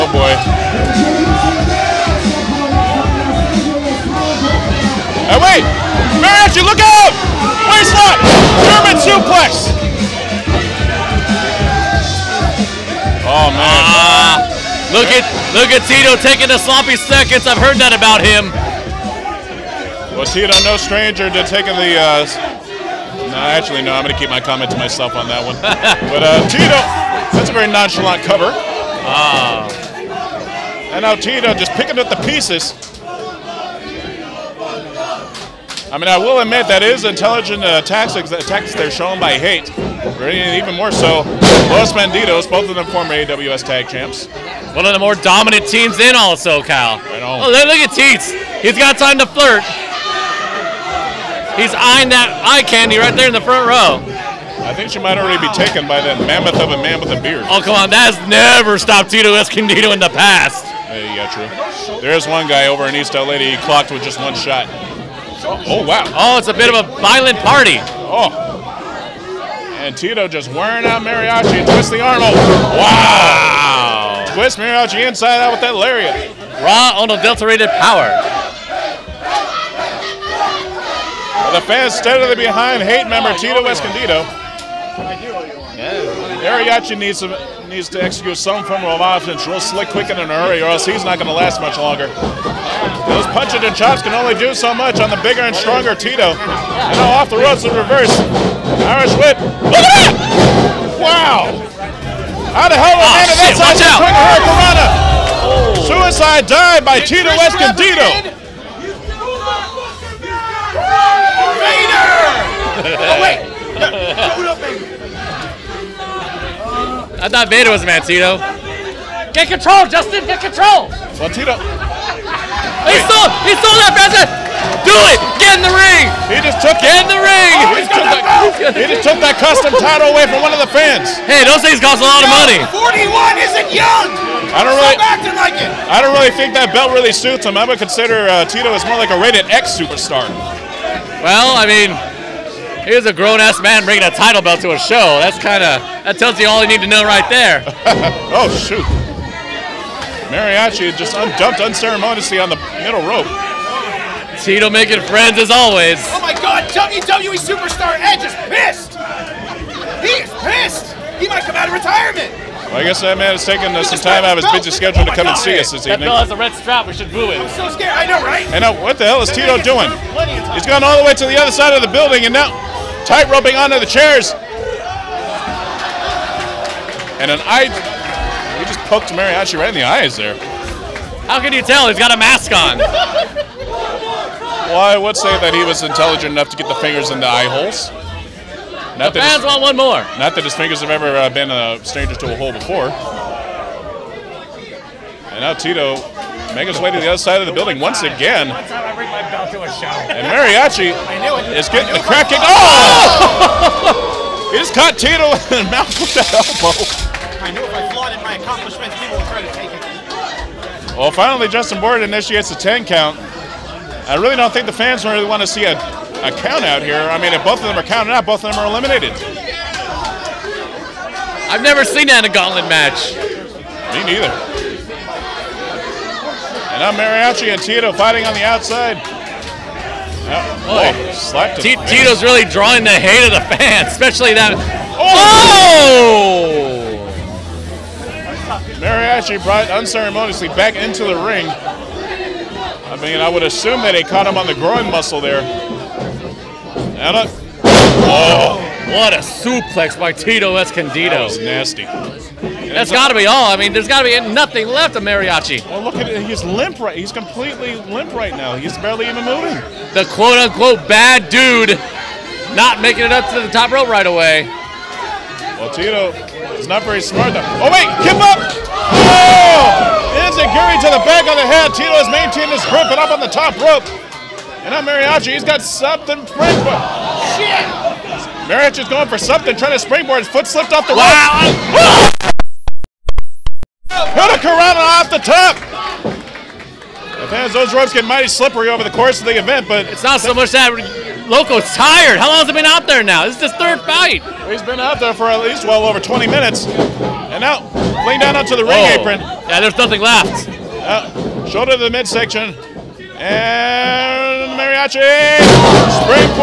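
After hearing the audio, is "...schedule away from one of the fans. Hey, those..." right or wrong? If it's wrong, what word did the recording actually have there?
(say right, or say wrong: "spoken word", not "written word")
wrong: "title", not "schedule".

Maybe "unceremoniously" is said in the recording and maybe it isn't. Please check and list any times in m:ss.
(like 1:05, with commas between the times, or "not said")
2:31, 3:59.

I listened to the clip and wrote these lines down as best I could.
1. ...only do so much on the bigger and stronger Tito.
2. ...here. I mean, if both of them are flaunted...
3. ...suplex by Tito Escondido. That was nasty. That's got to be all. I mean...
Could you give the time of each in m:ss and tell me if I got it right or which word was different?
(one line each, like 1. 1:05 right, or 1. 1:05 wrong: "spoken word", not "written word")
1. 1:34 right
2. 3:36 wrong: "counted", not "flaunted"
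3. 4:09 right.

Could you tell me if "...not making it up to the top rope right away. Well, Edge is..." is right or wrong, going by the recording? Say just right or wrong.
wrong.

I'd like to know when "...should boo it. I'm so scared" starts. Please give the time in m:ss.
2:46.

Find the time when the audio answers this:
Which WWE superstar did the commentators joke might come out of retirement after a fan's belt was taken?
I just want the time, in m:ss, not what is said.
2:38.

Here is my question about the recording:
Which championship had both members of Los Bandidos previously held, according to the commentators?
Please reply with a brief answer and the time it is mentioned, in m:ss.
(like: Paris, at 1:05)
AWS tag champs, at 0:43.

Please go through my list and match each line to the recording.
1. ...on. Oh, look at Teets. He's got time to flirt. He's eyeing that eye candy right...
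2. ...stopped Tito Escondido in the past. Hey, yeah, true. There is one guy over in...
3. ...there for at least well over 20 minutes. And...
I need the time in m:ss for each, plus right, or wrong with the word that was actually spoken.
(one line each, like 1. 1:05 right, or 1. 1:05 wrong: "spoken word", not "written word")
1. 0:47 right
2. 0:58 right
3. 4:54 right.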